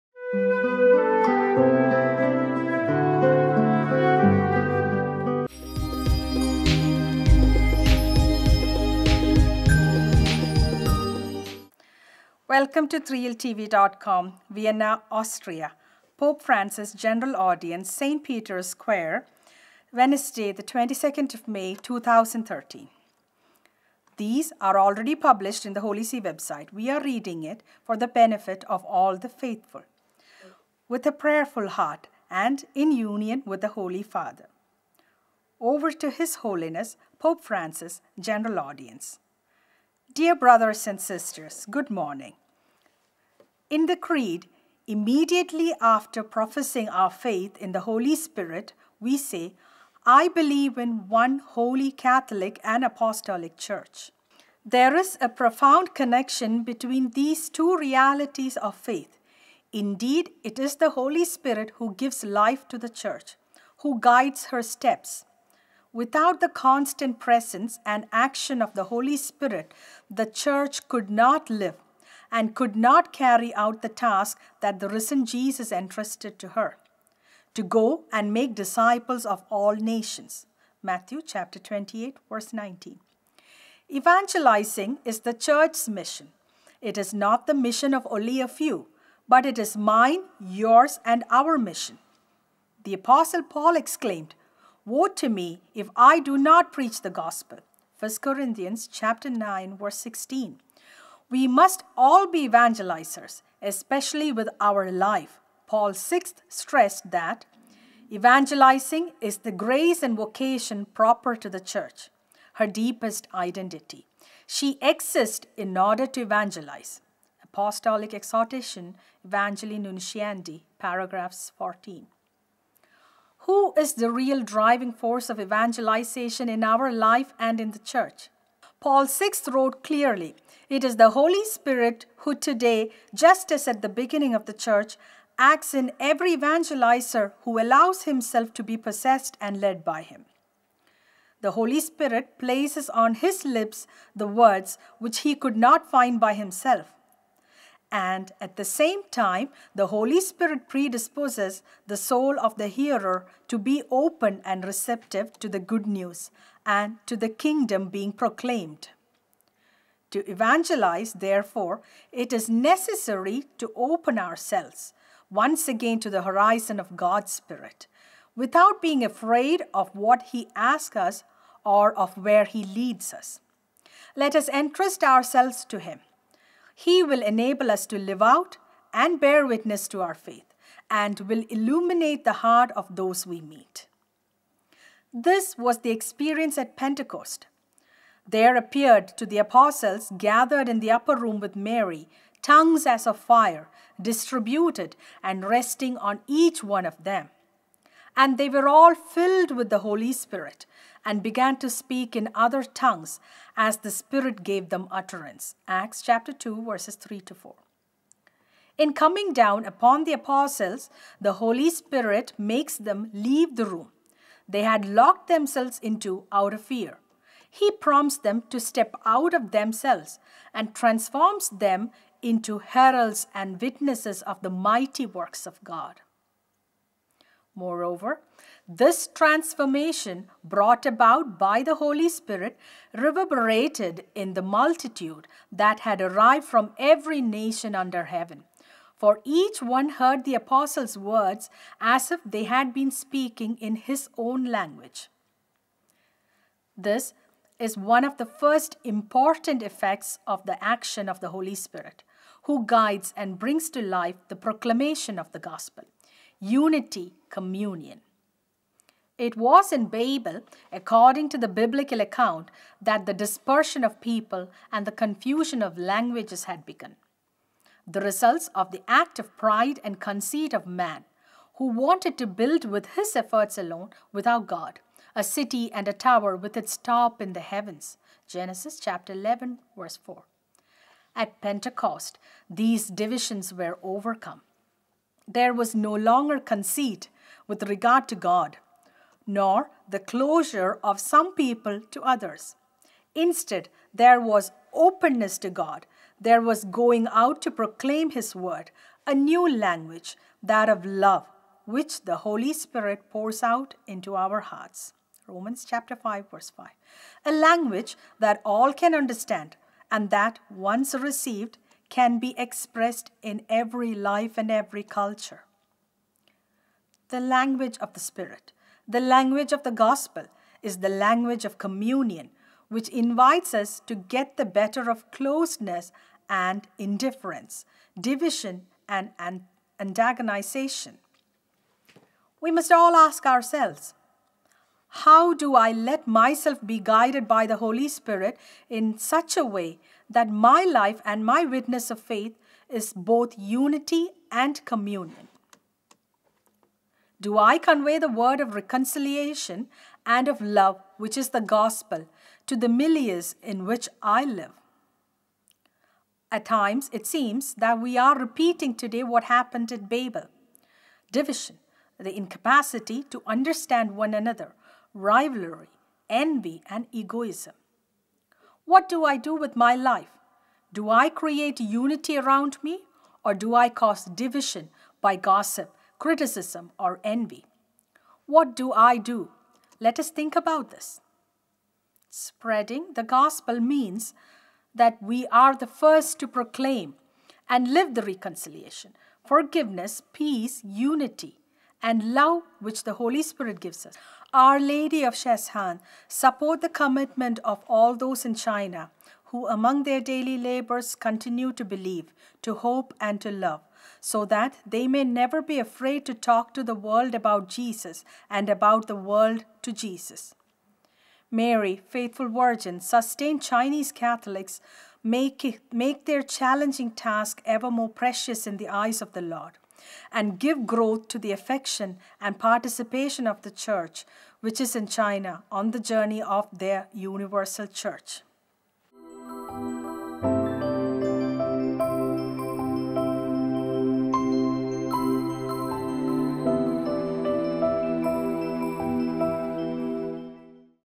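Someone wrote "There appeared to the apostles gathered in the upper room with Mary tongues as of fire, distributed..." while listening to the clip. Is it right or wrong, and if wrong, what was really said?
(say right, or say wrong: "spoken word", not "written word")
right.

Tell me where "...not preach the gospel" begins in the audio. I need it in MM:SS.
01:36.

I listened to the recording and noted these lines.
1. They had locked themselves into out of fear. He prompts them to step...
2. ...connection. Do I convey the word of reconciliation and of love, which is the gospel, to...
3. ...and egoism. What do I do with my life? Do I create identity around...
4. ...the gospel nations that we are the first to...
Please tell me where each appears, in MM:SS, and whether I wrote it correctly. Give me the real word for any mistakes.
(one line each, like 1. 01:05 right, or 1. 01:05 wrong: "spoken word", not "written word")
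1. 03:34 right
2. 05:44 wrong: "communion", not "connection"
3. 06:06 wrong: "unity", not "identity"
4. 06:22 wrong: "means", not "nations".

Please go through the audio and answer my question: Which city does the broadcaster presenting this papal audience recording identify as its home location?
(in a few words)
Vienna.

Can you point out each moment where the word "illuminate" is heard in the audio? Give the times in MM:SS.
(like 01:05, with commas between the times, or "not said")
03:01.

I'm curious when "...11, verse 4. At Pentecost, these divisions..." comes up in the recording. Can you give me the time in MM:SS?
04:39.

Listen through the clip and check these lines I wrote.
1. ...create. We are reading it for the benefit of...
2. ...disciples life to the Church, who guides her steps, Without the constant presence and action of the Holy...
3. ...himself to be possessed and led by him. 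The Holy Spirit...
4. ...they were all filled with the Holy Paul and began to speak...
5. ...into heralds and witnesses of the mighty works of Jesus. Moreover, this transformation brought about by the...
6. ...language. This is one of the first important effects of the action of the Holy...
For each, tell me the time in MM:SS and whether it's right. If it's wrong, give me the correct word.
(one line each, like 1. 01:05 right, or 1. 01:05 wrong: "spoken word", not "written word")
1. 00:26 wrong: "website", not "create"
2. 01:01 wrong: "gives", not "disciples"
3. 02:18 right
4. 03:18 wrong: "Spirit", not "Paul"
5. 03:42 wrong: "God", not "Jesus"
6. 04:04 right.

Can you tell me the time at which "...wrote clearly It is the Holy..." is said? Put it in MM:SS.
02:09.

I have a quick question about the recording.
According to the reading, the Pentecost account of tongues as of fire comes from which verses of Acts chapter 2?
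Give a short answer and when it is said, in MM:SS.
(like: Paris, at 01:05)
3 to 4, at 03:26.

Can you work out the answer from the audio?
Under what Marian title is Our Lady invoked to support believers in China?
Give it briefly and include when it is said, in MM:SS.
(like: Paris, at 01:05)
Our Lady of Sheshan, at 06:34.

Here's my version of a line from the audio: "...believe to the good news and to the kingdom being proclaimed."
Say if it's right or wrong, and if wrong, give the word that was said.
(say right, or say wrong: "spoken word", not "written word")
wrong: "receptive", not "believe".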